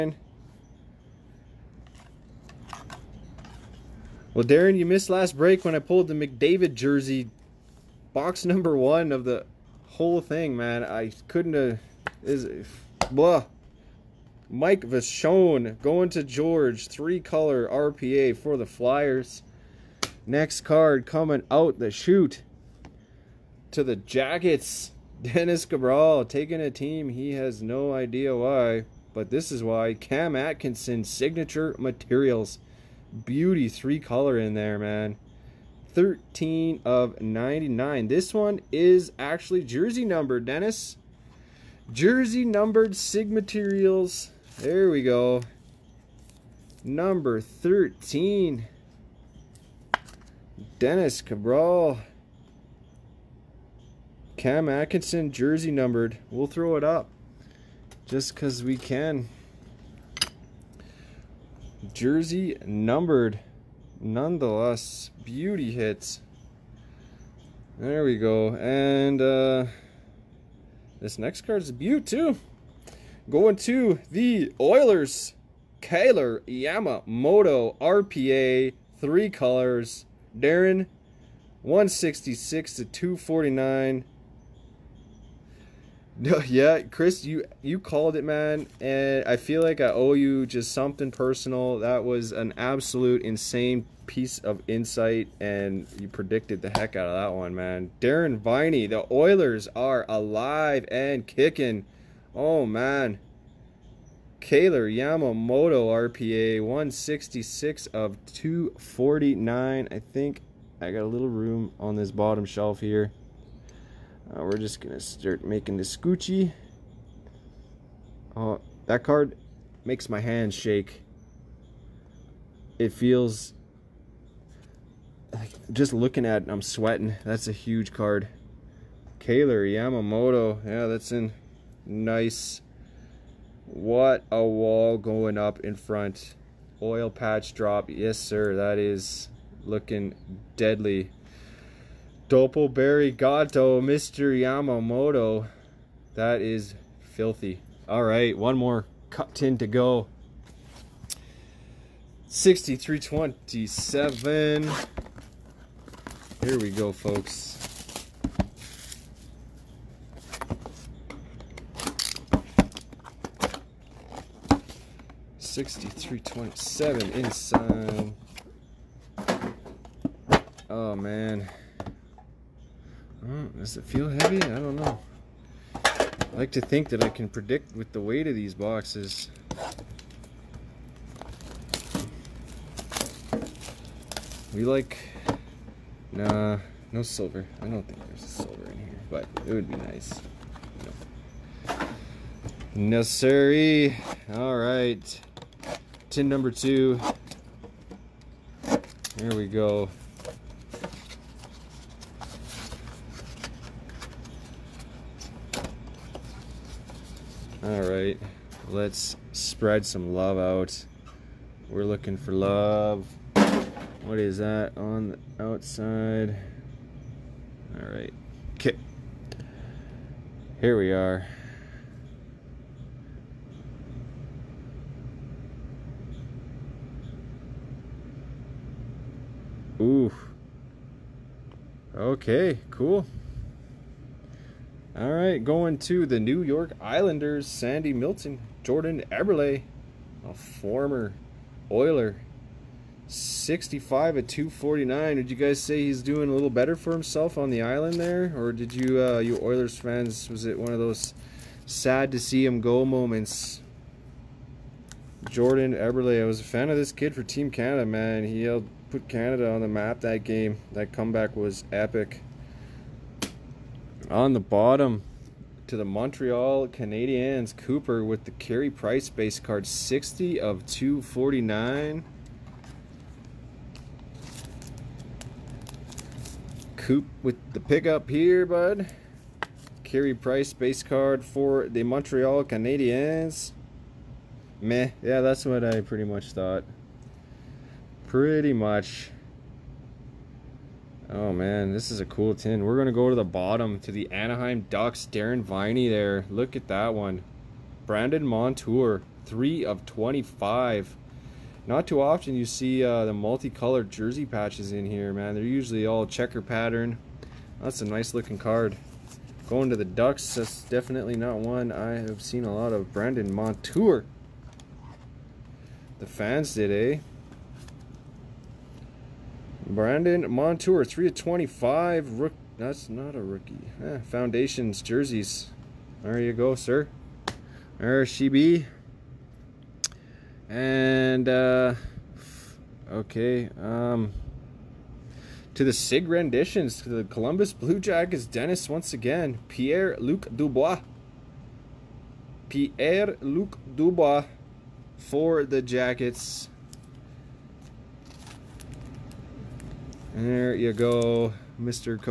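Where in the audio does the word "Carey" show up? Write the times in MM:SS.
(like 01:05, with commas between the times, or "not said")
04:28, 04:39.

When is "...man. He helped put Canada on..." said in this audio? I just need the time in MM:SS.
04:17.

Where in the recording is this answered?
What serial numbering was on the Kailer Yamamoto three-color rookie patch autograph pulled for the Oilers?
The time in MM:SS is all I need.
01:46.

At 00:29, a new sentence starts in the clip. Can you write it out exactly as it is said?
Cam Atkinson signature materials beauty three color in there, man.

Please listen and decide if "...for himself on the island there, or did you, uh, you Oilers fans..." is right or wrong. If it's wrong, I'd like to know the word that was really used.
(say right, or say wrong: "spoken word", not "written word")
right.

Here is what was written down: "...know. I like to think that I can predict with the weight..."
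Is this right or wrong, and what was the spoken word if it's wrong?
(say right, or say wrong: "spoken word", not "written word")
right.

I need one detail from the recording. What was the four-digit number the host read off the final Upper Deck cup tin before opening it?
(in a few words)
6327.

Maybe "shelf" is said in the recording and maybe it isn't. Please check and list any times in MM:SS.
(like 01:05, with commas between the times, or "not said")
01:52.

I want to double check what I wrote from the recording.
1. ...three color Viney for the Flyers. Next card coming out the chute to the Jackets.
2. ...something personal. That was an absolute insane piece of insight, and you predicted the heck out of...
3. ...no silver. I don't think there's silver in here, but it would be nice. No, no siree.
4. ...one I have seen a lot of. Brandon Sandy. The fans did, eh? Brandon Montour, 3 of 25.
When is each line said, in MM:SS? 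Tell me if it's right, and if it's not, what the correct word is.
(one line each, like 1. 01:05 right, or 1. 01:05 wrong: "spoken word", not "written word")
1. 00:16 wrong: "RPA", not "Viney"
2. 01:30 right
3. 03:06 right
4. 05:11 wrong: "Montour", not "Sandy".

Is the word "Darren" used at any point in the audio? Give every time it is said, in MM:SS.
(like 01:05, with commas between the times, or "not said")
00:04, 01:20, 01:37, 04:55.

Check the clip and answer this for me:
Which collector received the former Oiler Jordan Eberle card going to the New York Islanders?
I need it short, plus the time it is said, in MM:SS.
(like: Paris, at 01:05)
Sandy Milton, at 03:57.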